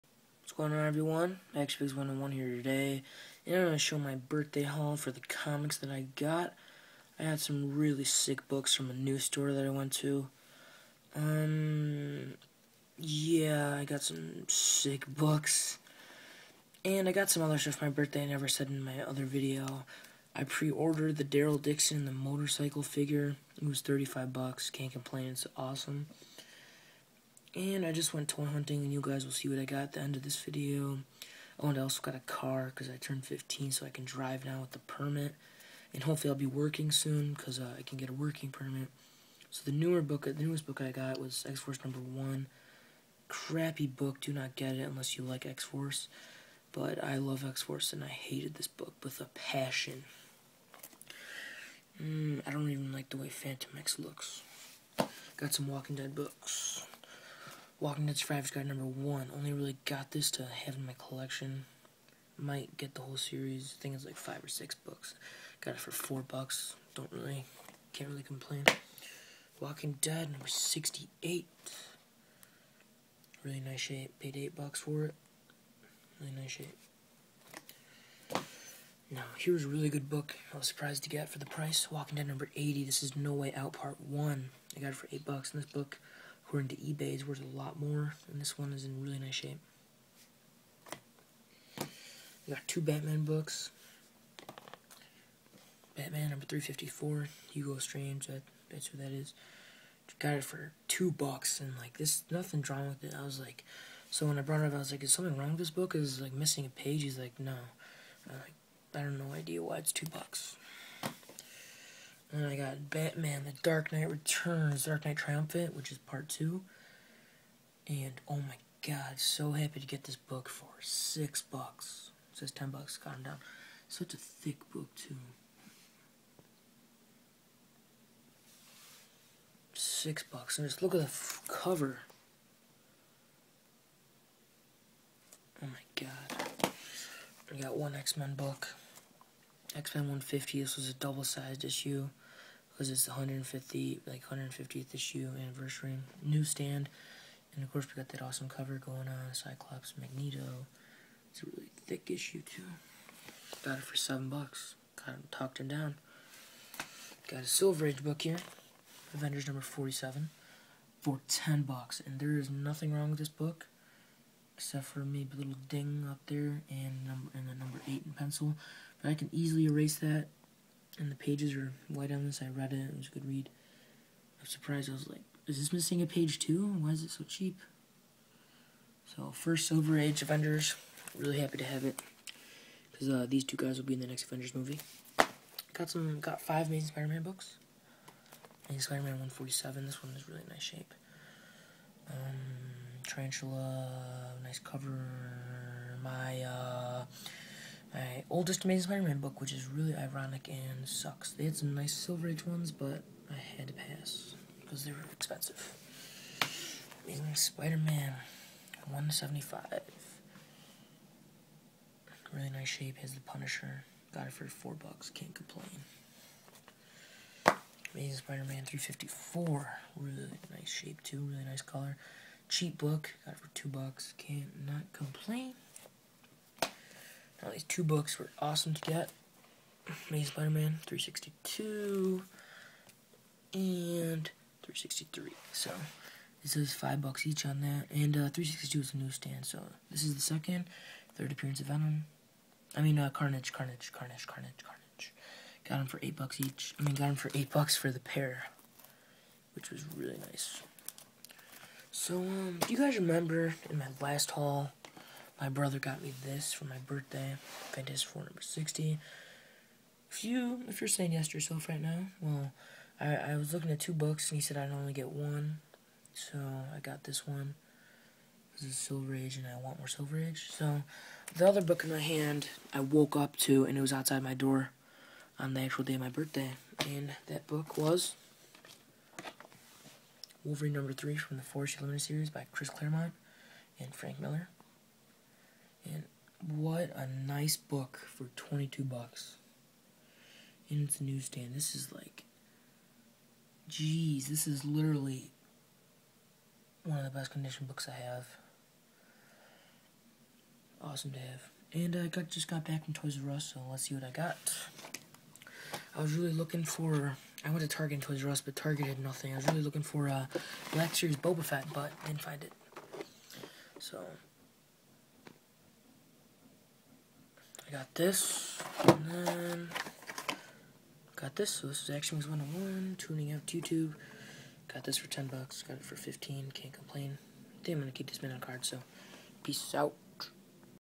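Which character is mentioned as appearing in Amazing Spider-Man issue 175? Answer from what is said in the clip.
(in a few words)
The Punisher.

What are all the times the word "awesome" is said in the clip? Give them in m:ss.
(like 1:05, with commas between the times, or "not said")
0:25, 2:28, 3:48, 5:00.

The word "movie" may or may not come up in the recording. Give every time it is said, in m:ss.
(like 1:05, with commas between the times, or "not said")
3:04.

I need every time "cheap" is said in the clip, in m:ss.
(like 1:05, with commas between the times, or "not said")
2:57, 3:42.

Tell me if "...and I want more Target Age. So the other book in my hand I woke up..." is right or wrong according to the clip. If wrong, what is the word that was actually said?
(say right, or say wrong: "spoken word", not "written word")
wrong: "Silver", not "Target".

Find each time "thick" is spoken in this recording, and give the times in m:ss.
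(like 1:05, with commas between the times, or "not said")
2:04, 2:31.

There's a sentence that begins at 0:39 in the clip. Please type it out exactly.
So the newer book, the newest book I got was X Force number one.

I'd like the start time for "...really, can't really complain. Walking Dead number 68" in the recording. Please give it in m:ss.
1:07.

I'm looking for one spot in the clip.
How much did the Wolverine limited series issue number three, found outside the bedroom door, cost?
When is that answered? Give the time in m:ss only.
4:48.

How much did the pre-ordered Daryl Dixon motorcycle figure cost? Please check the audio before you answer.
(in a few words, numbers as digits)
$35.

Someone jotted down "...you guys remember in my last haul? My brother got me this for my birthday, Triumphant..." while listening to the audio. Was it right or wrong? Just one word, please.
wrong.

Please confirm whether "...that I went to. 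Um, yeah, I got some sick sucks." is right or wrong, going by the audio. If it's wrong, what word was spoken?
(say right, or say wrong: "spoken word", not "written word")
wrong: "books", not "sucks".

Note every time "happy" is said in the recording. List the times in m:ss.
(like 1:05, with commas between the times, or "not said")
1:59, 3:01.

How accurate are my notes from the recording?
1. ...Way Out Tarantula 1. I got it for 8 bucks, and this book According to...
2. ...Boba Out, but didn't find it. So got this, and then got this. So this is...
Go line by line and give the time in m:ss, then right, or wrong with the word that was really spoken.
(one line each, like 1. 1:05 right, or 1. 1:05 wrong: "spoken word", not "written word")
1. 1:23 wrong: "Part", not "Tarantula"
2. 5:11 wrong: "Fett", not "Out".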